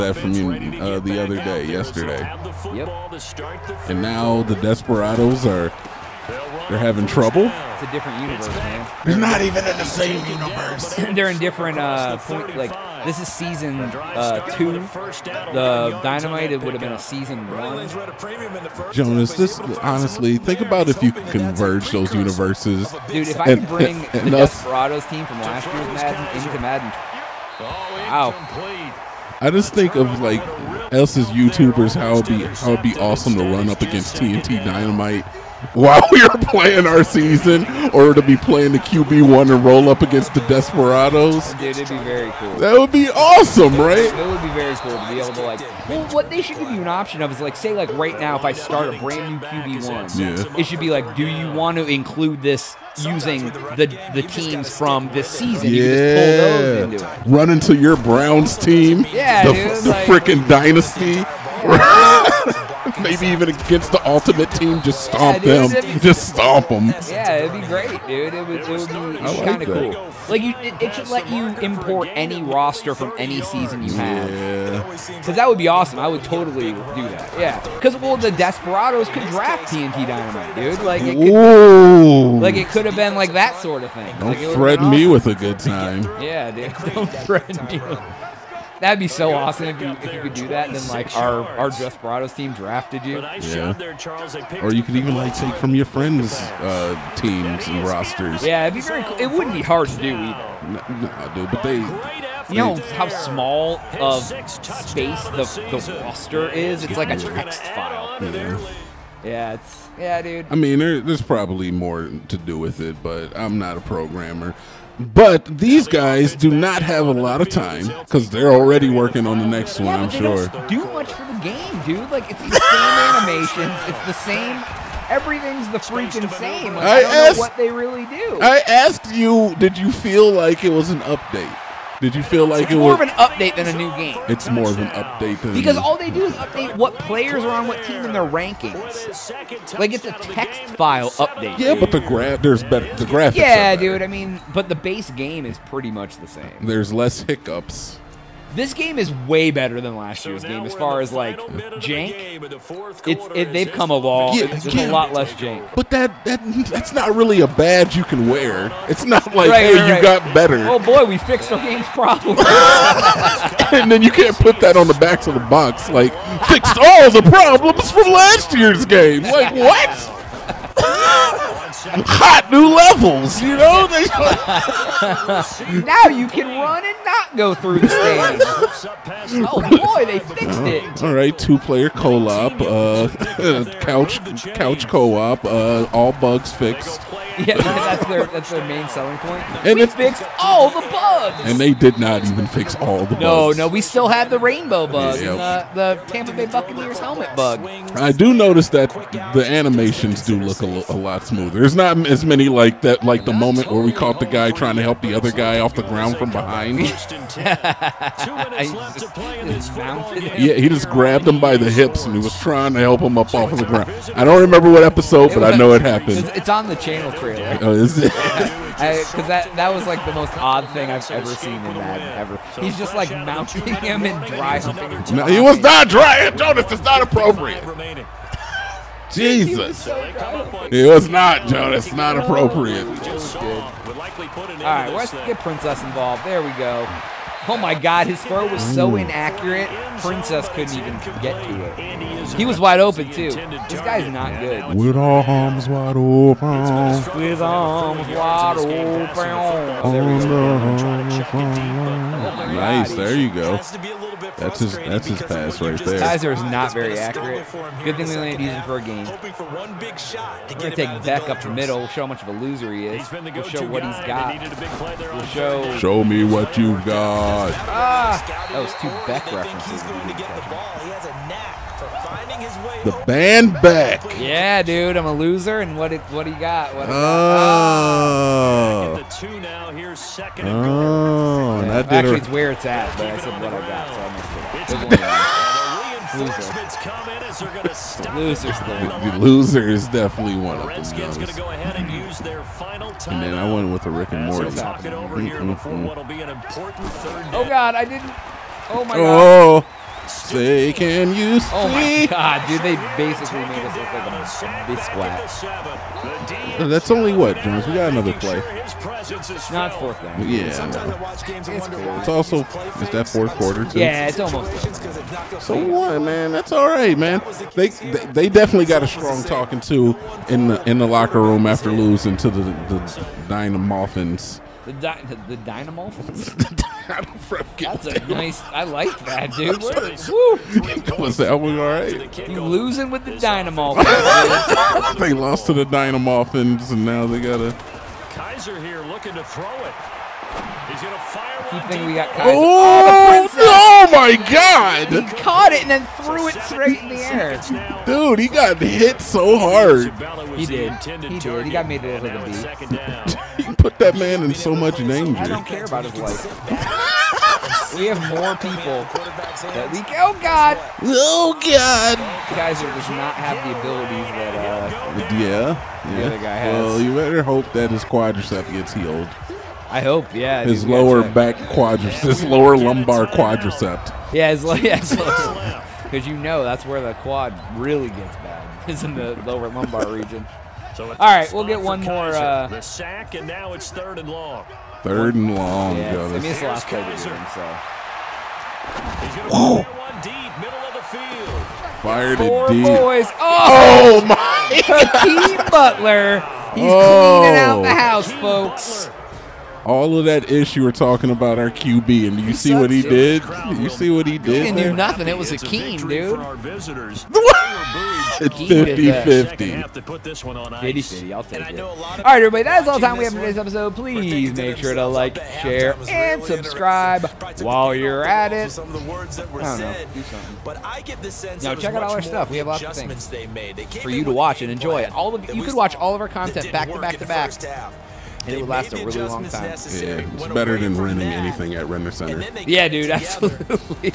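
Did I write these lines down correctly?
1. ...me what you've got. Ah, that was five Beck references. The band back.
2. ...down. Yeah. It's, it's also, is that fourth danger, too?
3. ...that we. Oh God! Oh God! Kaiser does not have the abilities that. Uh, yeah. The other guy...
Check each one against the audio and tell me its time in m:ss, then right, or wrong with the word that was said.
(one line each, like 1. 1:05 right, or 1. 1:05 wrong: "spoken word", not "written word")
1. 4:26 wrong: "two", not "five"
2. 5:10 wrong: "quarter", not "danger"
3. 5:59 right.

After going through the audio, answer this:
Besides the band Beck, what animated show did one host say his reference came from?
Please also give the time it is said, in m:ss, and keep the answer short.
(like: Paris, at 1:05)
Rick and Morty, at 4:53.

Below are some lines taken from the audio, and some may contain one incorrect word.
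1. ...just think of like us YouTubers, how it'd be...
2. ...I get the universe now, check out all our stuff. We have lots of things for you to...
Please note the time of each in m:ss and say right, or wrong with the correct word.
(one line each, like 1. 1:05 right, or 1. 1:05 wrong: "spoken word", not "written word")
1. 0:29 right
2. 7:00 wrong: "sense", not "universe".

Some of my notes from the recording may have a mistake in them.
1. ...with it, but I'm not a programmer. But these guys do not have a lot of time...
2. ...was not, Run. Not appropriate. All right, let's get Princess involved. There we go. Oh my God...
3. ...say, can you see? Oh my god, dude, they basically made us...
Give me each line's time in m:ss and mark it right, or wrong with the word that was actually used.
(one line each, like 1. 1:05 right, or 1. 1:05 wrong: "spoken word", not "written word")
1. 1:52 right
2. 3:50 wrong: "Jonas", not "Run"
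3. 5:00 right.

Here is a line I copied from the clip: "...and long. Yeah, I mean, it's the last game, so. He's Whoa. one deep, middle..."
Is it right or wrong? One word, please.
right.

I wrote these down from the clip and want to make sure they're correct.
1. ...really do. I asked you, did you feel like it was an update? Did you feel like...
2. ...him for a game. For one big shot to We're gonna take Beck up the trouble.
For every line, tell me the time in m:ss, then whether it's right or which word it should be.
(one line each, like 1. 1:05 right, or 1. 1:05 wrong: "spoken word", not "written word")
1. 2:07 right
2. 4:18 wrong: "middle", not "trouble".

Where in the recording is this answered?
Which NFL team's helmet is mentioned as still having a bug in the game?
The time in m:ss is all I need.
3:16.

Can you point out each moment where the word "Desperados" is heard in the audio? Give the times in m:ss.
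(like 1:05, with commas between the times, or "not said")
0:04, 0:24, 0:40, 1:18, 1:31.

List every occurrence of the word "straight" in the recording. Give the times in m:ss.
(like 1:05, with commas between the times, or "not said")
5:46.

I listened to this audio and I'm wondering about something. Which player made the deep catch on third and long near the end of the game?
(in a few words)
Hakeem Butler.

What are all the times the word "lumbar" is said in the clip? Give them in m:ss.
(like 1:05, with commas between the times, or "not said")
6:12, 6:19.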